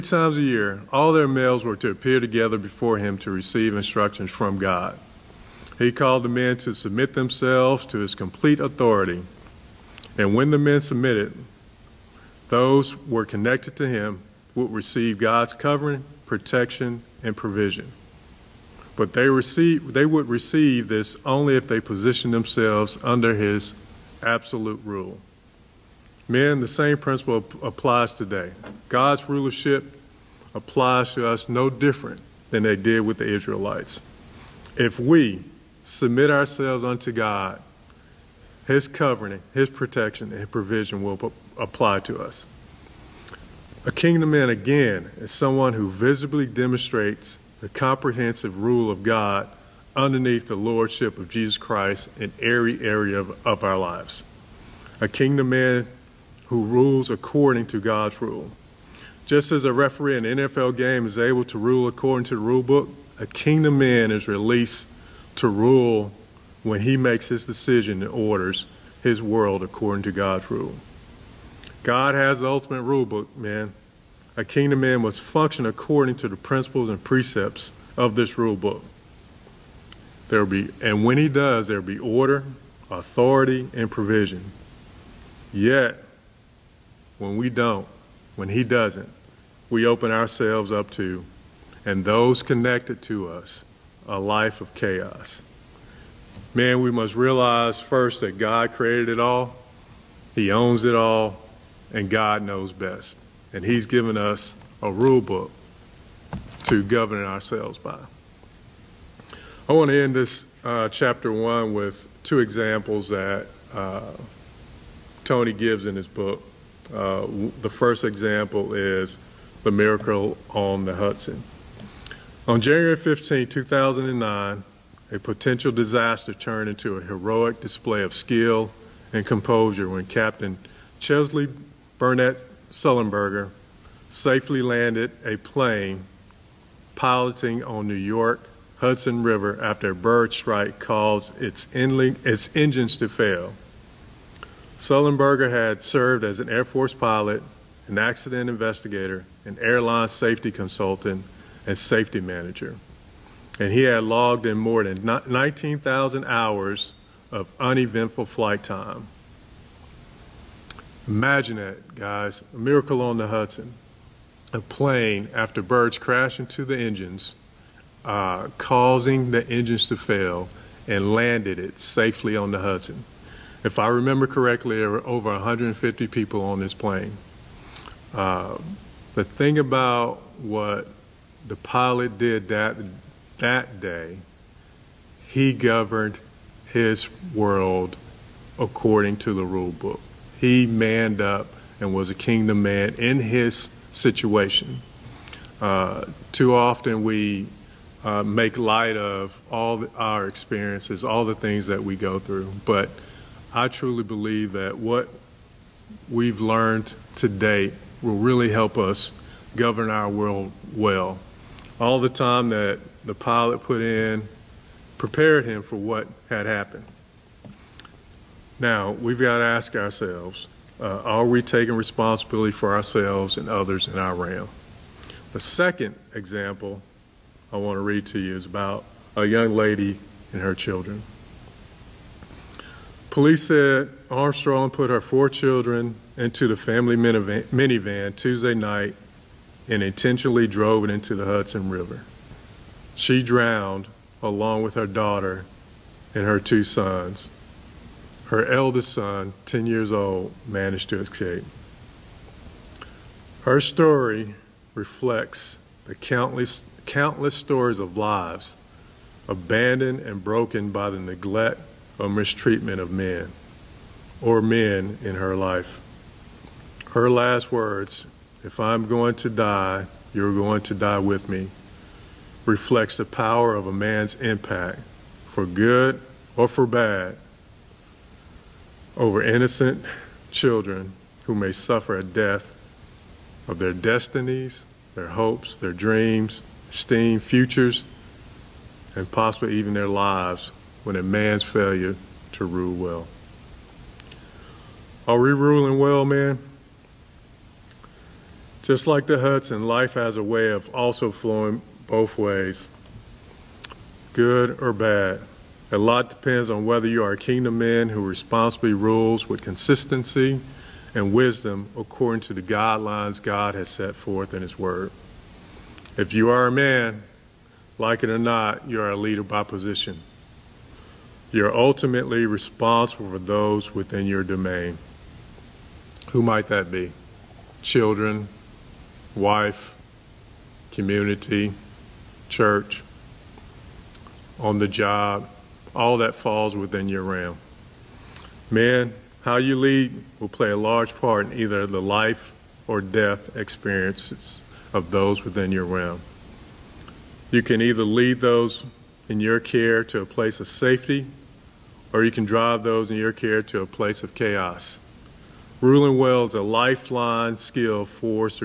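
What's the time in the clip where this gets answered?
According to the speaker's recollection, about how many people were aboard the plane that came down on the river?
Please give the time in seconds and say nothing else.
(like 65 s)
175 s.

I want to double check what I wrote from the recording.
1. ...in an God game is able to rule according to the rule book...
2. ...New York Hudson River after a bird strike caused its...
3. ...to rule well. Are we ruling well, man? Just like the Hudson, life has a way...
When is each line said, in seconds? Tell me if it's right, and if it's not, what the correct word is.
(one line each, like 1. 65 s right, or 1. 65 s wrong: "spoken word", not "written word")
1. 60 s wrong: "NFL", not "God"
2. 137 s right
3. 292 s right.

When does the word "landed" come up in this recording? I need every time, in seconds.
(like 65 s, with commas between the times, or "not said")
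134 s, 171 s.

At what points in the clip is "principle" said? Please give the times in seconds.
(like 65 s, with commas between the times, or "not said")
26 s, 76 s.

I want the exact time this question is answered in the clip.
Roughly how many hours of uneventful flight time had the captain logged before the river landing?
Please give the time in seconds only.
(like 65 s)
155 s.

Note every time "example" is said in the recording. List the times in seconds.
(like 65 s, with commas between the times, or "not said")
112 s, 118 s, 226 s.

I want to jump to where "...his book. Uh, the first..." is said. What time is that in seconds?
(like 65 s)
115 s.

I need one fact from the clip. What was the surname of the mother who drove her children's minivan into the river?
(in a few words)
Armstrong.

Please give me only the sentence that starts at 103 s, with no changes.
And he's given us a rule book to govern ourselves by.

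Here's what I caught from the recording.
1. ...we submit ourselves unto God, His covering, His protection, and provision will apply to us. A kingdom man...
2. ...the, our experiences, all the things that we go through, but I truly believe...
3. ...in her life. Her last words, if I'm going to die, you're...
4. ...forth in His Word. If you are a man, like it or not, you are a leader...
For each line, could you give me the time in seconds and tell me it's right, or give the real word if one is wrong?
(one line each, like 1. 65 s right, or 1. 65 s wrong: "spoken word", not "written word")
1. 34 s right
2. 199 s right
3. 265 s right
4. 313 s right.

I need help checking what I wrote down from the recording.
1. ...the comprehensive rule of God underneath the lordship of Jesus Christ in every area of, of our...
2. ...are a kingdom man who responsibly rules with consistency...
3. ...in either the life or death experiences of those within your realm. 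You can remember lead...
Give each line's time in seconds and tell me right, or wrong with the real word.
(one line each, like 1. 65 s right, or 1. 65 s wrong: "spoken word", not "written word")
1. 47 s right
2. 307 s right
3. 341 s wrong: "either", not "remember".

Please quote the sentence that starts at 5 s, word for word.
He called the men to submit themselves to his complete authority.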